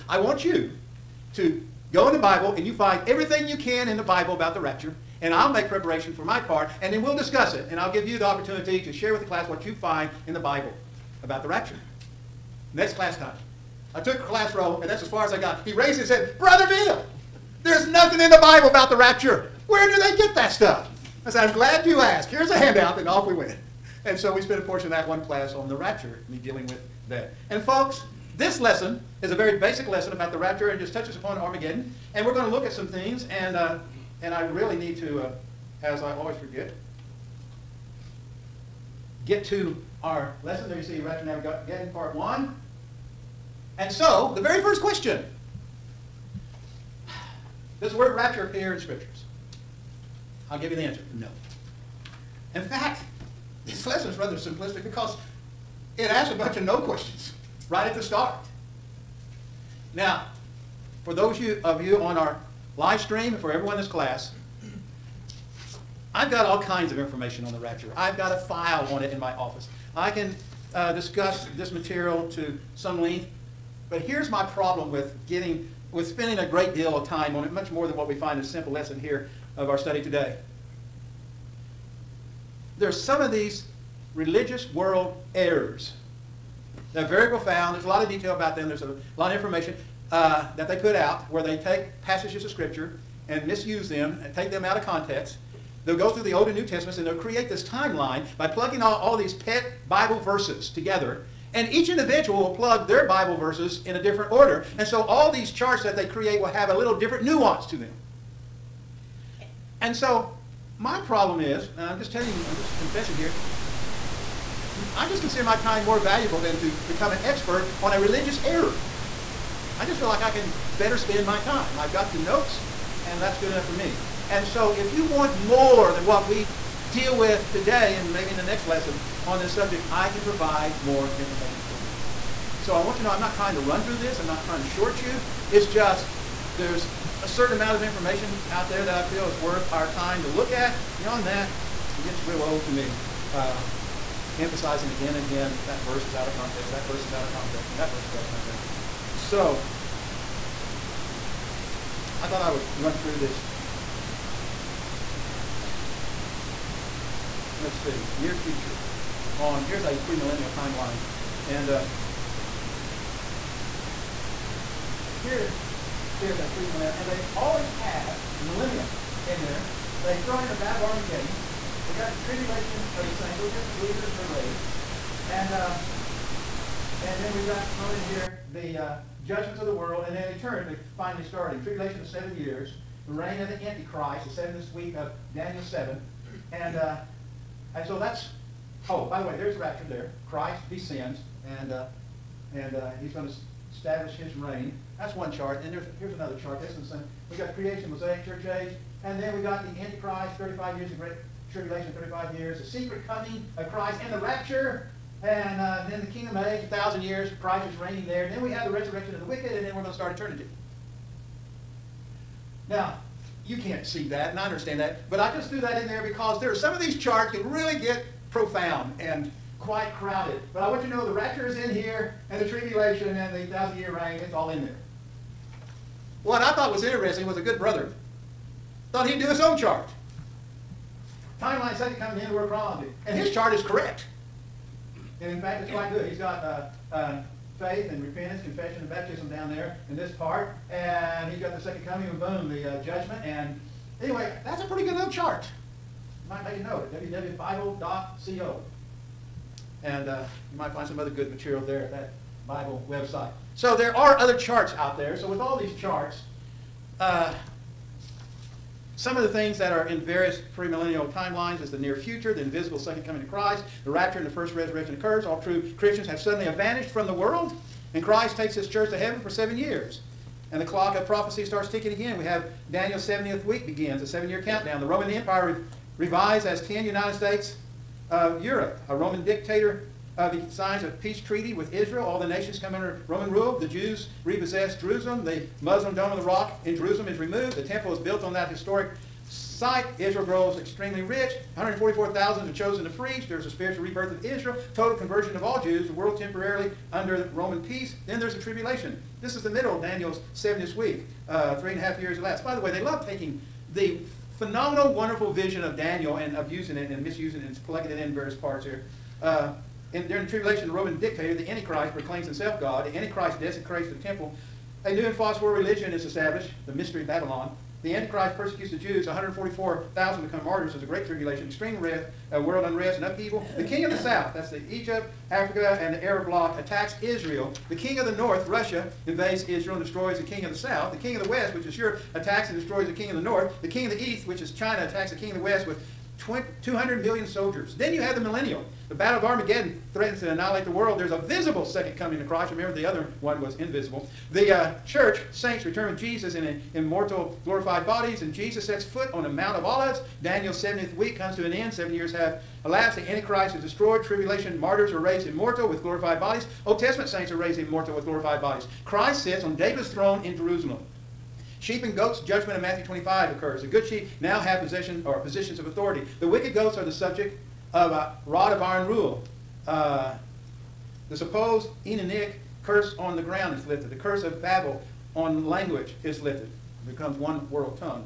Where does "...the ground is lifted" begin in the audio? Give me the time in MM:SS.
06:13.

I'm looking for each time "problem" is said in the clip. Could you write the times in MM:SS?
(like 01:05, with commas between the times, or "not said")
01:14, 01:51.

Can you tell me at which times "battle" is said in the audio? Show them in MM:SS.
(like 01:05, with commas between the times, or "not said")
02:50, 05:38.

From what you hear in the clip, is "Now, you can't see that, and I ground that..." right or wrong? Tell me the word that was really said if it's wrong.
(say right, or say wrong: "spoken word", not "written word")
wrong: "understand", not "ground".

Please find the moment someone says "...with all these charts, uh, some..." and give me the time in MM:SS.
04:15.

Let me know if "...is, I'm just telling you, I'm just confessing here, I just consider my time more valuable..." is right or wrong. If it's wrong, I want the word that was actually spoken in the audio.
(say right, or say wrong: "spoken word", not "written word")
right.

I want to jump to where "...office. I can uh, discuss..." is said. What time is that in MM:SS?
01:09.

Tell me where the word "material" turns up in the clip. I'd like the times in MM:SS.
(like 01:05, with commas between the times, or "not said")
01:11, 04:11.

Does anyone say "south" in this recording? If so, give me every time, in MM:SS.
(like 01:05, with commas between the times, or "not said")
05:23, 05:30.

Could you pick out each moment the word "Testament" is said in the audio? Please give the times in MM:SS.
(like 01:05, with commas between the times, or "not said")
01:36, 02:53, 05:56.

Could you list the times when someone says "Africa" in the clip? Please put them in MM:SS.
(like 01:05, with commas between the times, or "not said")
05:25.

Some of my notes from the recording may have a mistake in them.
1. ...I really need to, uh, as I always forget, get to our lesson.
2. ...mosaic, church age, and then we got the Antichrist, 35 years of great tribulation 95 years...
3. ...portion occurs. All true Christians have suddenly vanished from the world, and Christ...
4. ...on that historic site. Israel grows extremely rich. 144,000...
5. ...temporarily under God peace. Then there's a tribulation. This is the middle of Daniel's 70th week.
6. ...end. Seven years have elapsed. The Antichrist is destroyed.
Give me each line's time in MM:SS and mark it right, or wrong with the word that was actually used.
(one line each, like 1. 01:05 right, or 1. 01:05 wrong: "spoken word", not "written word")
1. 00:34 right
2. 03:17 wrong: "35", not "95"
3. 04:24 wrong: "resurrection", not "portion"
4. 04:48 right
5. 04:56 wrong: "Roman", not "God"
6. 05:51 right.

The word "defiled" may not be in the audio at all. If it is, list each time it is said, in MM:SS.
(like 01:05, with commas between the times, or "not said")
not said.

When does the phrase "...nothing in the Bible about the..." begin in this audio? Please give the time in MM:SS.
00:17.